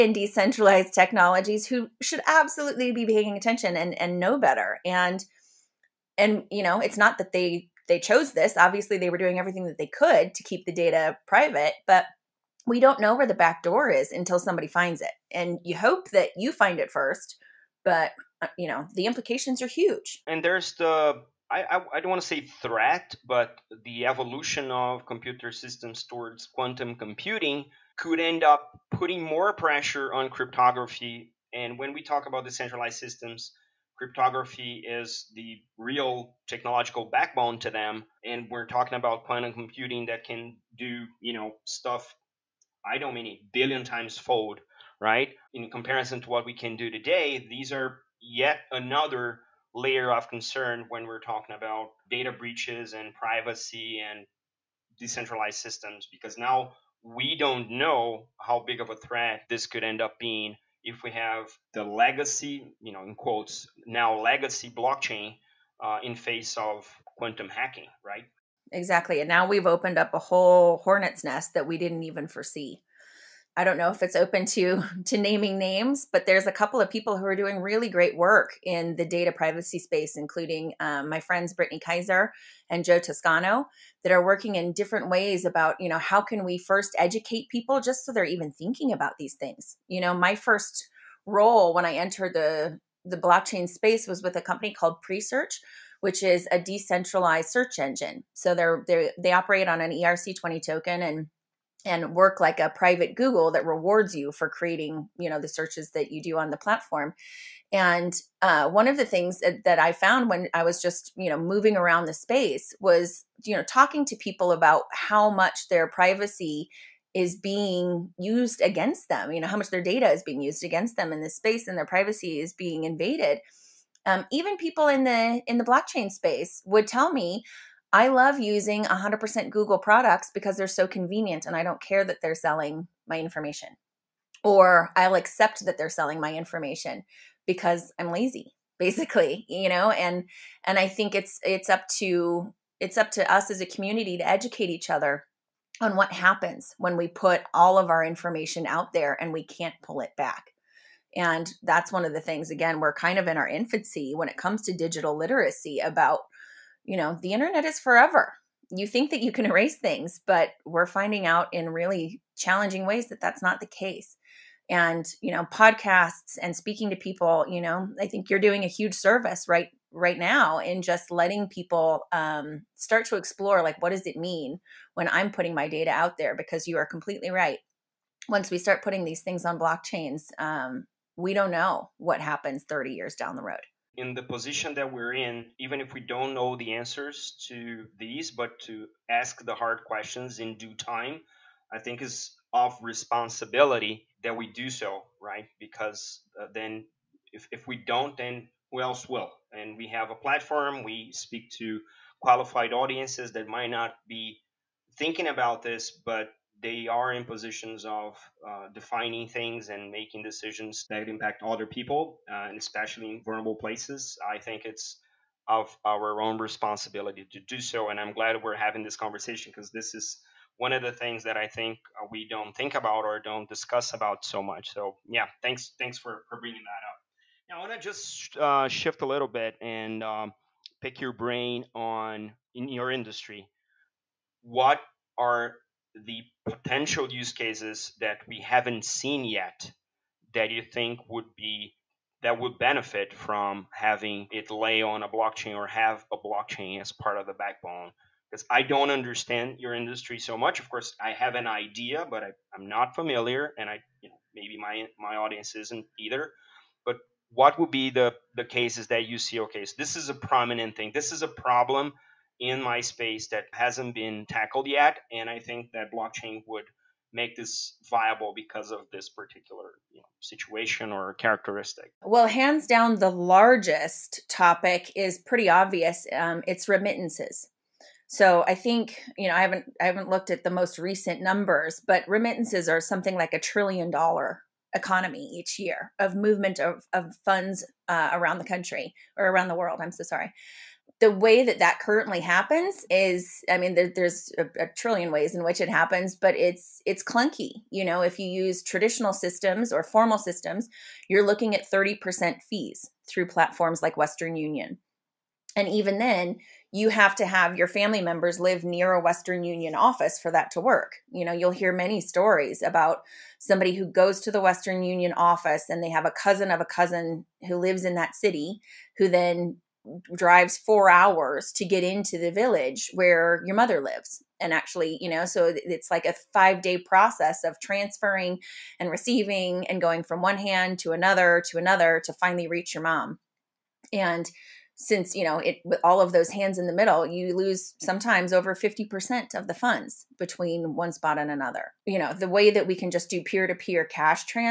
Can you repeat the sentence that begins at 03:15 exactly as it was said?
Because uh, then if, if we don't, then who else will?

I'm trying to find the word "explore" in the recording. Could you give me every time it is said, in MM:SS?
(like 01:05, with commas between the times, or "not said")
02:53.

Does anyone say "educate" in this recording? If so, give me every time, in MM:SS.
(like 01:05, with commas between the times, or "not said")
01:26, 02:24.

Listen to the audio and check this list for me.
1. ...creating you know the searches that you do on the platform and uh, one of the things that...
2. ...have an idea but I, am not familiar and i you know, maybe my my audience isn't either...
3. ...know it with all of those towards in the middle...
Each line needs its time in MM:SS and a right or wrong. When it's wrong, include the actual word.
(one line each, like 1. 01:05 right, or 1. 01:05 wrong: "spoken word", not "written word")
1. 01:44 right
2. 04:11 right
3. 05:35 wrong: "hands", not "towards".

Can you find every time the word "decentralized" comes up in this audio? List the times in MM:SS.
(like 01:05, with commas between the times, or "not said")
00:00, 00:32, 00:54, 01:36.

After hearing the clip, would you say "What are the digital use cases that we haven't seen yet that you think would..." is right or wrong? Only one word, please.
wrong.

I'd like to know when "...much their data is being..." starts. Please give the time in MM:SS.
01:59.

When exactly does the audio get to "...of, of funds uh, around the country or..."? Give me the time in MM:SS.
04:46.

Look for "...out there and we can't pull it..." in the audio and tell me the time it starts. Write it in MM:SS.
02:28.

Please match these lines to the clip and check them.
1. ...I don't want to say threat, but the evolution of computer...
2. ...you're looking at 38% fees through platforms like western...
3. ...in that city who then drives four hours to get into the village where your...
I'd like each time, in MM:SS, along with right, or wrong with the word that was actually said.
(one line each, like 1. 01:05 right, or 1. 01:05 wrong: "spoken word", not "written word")
1. 00:21 right
2. 05:01 wrong: "30", not "38"
3. 05:17 right.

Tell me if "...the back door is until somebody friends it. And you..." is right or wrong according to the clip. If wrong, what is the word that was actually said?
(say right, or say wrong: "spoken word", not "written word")
wrong: "finds", not "friends".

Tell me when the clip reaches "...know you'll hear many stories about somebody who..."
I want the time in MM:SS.
05:11.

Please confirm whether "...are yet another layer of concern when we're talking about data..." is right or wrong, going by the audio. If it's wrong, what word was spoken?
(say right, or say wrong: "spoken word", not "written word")
right.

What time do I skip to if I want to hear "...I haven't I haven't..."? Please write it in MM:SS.
04:39.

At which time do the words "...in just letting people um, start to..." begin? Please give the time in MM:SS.
02:50.